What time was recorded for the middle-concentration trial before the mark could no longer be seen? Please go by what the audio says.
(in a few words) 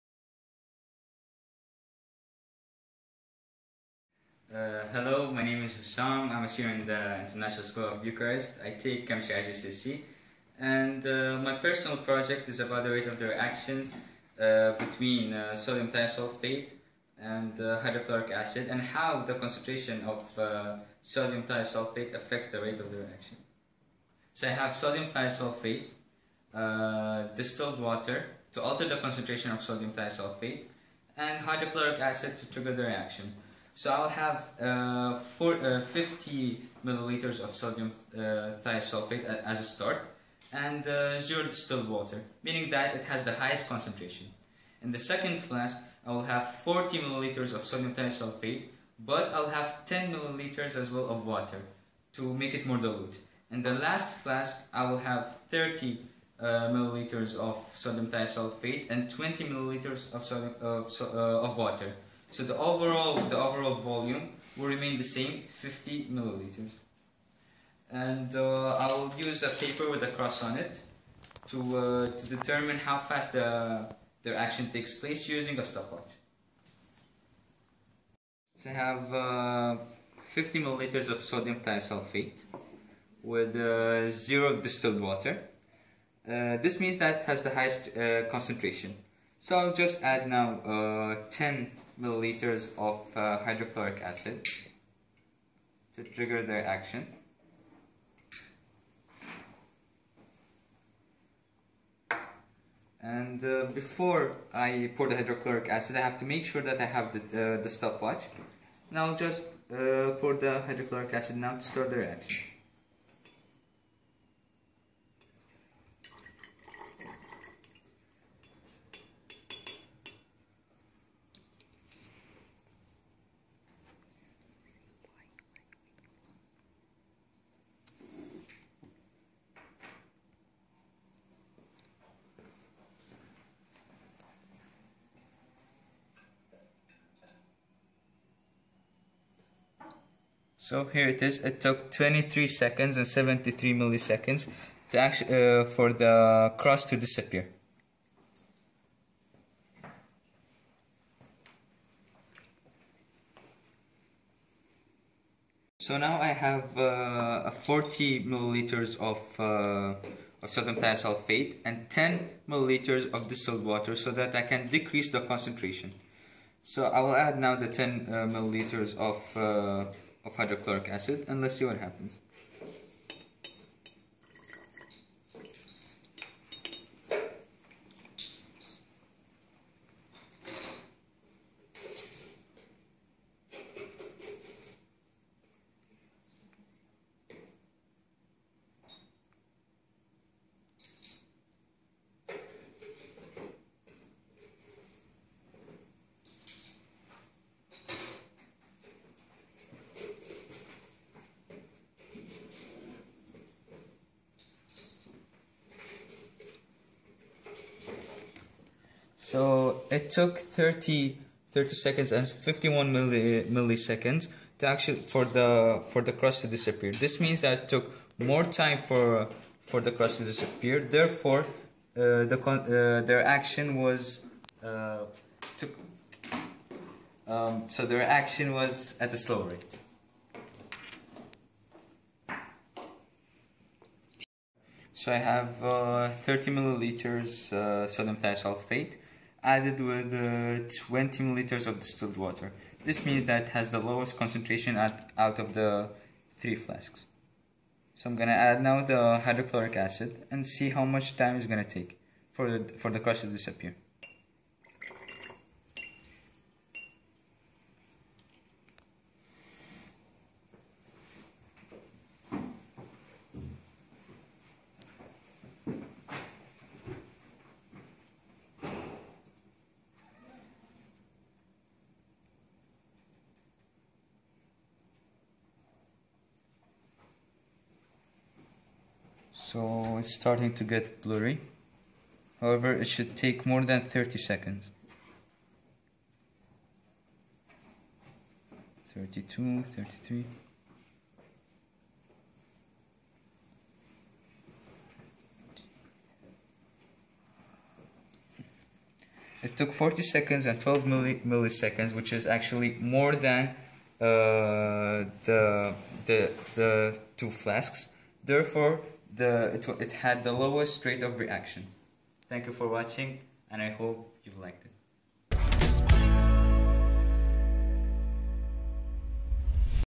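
30 seconds and 51 milliseconds.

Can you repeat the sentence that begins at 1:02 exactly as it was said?
So the overall the overall volume will remain the same, 50 milliliters.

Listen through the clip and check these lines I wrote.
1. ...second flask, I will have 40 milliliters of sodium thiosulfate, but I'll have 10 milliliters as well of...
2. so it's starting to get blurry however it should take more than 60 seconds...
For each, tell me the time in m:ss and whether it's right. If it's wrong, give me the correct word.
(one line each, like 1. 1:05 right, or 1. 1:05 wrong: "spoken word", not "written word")
1. 0:44 right
2. 4:39 wrong: "30", not "60".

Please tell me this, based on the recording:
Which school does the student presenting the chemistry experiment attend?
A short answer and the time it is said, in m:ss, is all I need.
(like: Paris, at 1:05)
International School of Bucharest, at 0:07.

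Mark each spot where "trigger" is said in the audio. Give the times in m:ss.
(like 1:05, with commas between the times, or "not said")
0:32, 1:36.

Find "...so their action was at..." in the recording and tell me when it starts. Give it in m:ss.
3:47.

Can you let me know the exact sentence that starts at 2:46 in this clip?
So I will add now the 10 uh, milliliters of uh, of hydrochloric acid and let's see what happens.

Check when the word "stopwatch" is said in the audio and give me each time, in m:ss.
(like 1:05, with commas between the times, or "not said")
1:15, 1:47.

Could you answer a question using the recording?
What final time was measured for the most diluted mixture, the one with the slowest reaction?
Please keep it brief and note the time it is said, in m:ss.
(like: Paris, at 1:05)
40 seconds and 12 milliseconds, at 4:59.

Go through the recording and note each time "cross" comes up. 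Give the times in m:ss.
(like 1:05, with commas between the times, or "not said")
1:10, 2:26.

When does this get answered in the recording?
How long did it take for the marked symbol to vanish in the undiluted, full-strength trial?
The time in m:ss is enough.
2:21.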